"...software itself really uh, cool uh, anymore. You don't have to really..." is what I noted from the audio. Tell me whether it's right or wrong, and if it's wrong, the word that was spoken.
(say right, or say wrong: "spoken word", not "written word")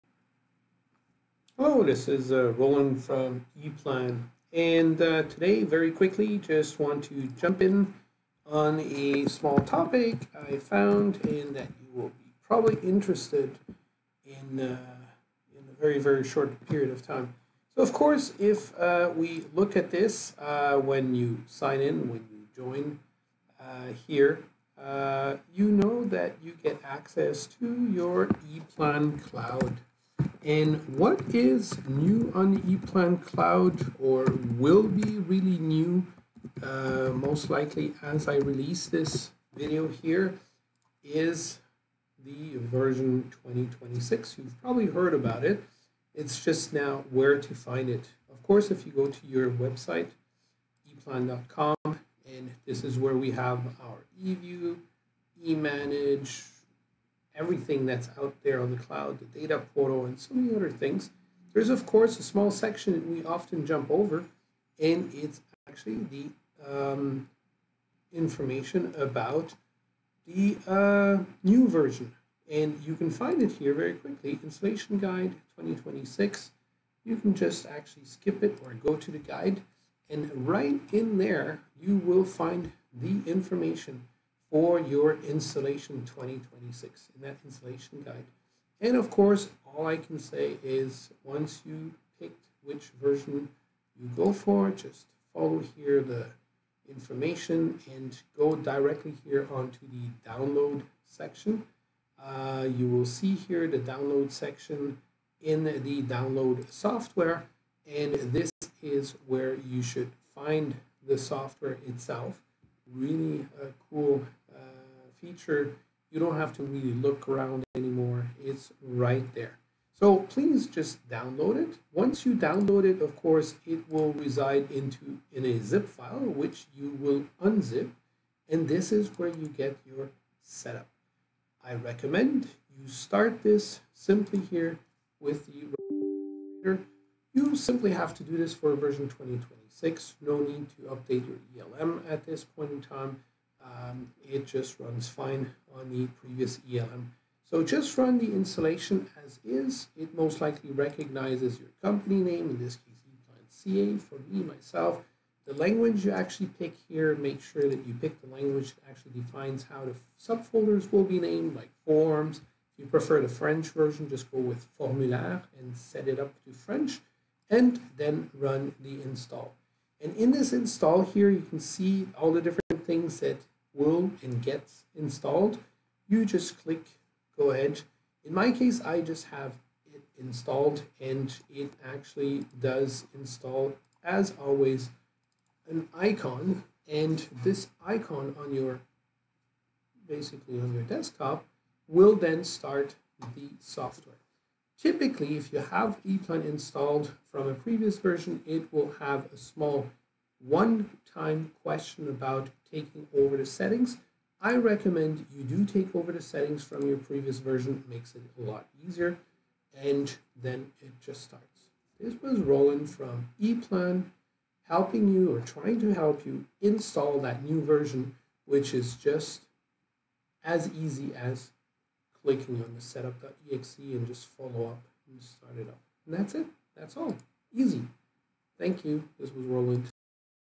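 wrong: "feature", not "anymore".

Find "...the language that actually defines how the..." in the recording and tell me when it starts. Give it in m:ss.
2:38.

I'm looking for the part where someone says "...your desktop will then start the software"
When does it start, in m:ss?
3:10.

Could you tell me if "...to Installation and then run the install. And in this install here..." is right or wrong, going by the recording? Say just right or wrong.
wrong.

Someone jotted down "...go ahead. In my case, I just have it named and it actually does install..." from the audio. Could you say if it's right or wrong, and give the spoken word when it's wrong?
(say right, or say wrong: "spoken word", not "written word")
wrong: "installed", not "named".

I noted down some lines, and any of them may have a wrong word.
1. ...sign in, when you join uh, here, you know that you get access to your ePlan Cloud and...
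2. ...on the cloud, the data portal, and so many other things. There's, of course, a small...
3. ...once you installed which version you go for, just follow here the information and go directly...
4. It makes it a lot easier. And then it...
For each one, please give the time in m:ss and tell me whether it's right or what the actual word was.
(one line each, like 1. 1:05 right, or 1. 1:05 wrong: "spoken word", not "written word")
1. 0:21 right
2. 0:58 right
3. 1:31 wrong: "picked", not "installed"
4. 3:27 right.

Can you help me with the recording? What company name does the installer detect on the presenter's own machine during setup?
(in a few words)
ePlan CA.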